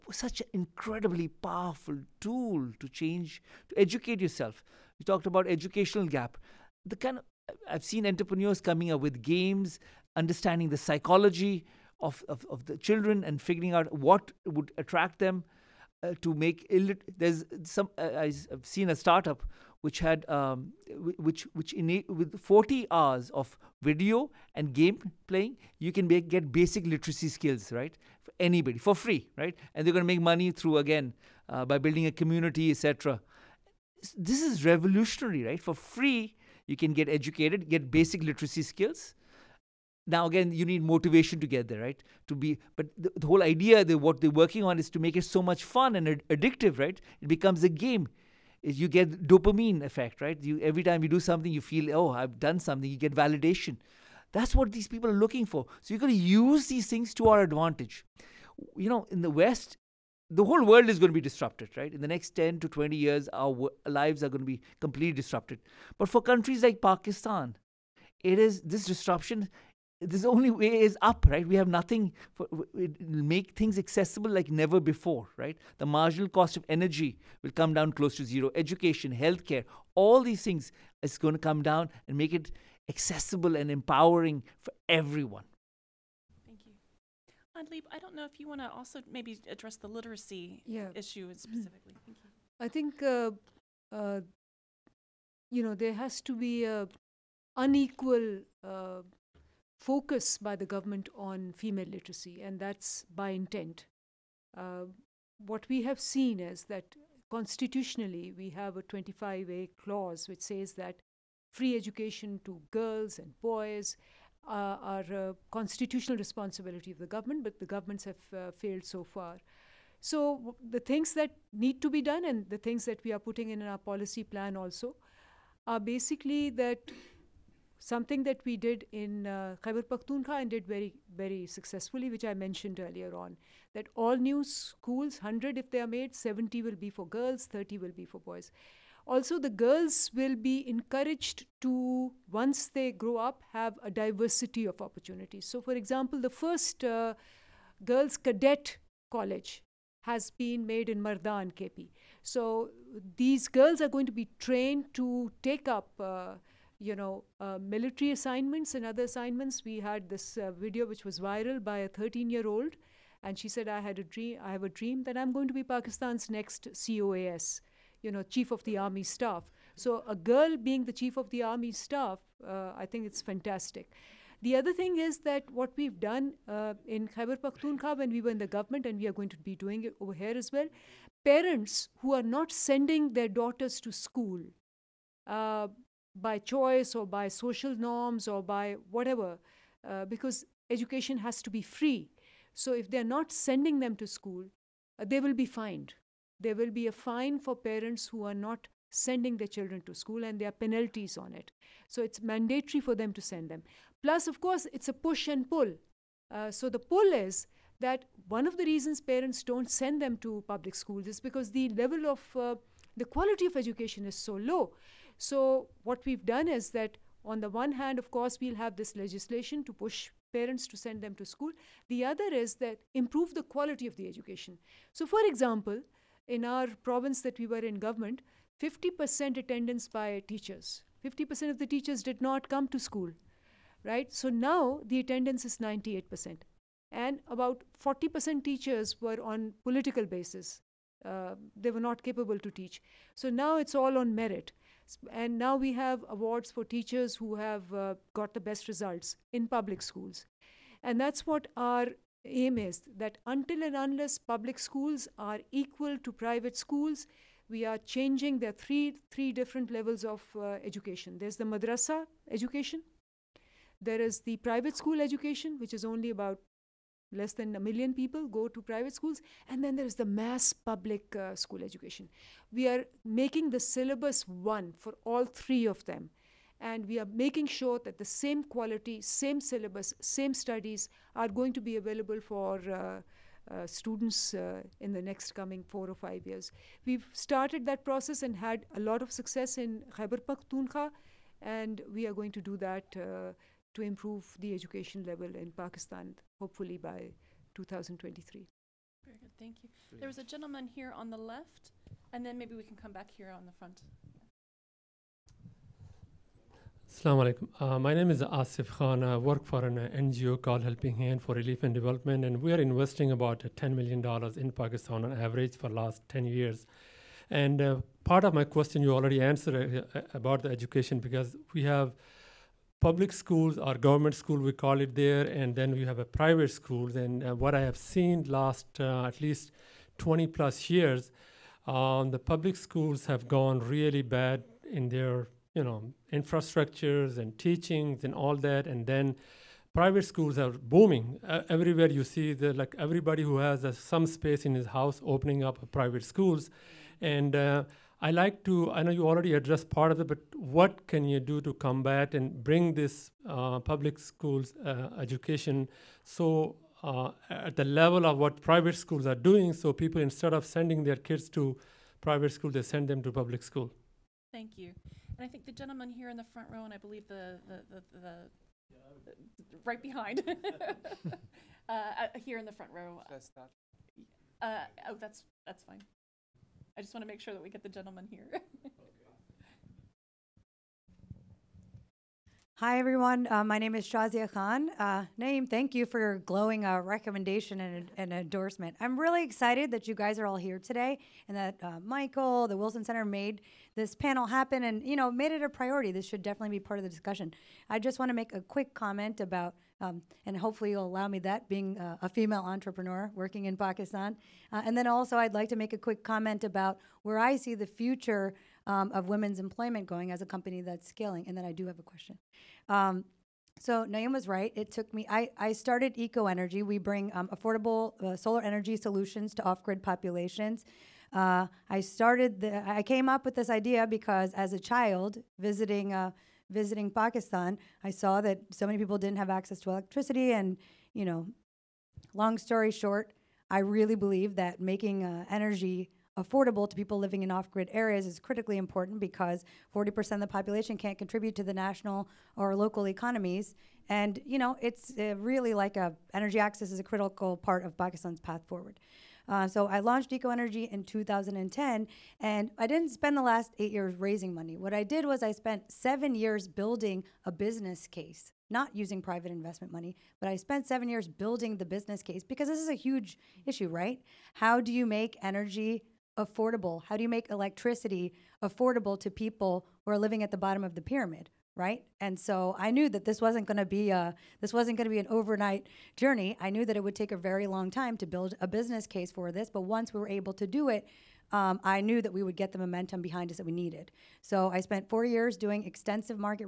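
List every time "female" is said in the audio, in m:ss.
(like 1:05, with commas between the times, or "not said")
1:41, 6:42.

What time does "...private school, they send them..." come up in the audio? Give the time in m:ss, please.
6:02.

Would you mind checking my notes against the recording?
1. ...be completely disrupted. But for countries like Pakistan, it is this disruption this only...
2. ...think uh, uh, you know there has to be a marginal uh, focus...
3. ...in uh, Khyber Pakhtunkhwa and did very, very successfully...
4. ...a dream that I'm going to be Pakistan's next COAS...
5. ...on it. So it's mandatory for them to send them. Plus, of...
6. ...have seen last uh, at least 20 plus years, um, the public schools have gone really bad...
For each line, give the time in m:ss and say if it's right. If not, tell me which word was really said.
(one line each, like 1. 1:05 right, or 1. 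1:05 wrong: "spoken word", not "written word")
1. 1:04 right
2. 1:32 wrong: "unequal", not "marginal"
3. 2:08 right
4. 2:44 right
5. 3:21 right
6. 5:27 right.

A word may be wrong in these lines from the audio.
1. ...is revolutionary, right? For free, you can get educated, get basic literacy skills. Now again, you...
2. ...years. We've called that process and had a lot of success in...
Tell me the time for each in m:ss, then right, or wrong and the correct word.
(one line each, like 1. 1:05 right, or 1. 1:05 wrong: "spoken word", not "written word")
1. 0:34 right
2. 4:46 wrong: "started", not "called".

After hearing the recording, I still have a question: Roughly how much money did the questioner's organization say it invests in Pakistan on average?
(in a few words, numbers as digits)
$10 million.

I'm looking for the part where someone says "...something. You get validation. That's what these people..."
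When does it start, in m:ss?
0:52.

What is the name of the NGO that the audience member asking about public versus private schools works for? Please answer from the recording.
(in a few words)
Helping Hand for Relief and Development.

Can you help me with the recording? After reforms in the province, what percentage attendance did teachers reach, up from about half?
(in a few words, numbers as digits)
98%.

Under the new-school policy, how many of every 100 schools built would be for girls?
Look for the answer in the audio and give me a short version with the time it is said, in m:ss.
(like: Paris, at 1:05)
70, at 2:16.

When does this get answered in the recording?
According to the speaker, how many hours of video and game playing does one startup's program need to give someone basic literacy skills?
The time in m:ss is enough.
0:22.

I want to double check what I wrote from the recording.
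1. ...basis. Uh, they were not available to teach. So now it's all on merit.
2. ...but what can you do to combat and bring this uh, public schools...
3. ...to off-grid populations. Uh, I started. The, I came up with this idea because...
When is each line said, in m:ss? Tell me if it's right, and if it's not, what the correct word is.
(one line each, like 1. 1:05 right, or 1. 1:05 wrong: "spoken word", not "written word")
1. 4:00 wrong: "capable", not "available"
2. 5:50 right
3. 6:59 right.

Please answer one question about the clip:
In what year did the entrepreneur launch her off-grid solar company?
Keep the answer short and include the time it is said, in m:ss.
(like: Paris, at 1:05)
2010, at 7:30.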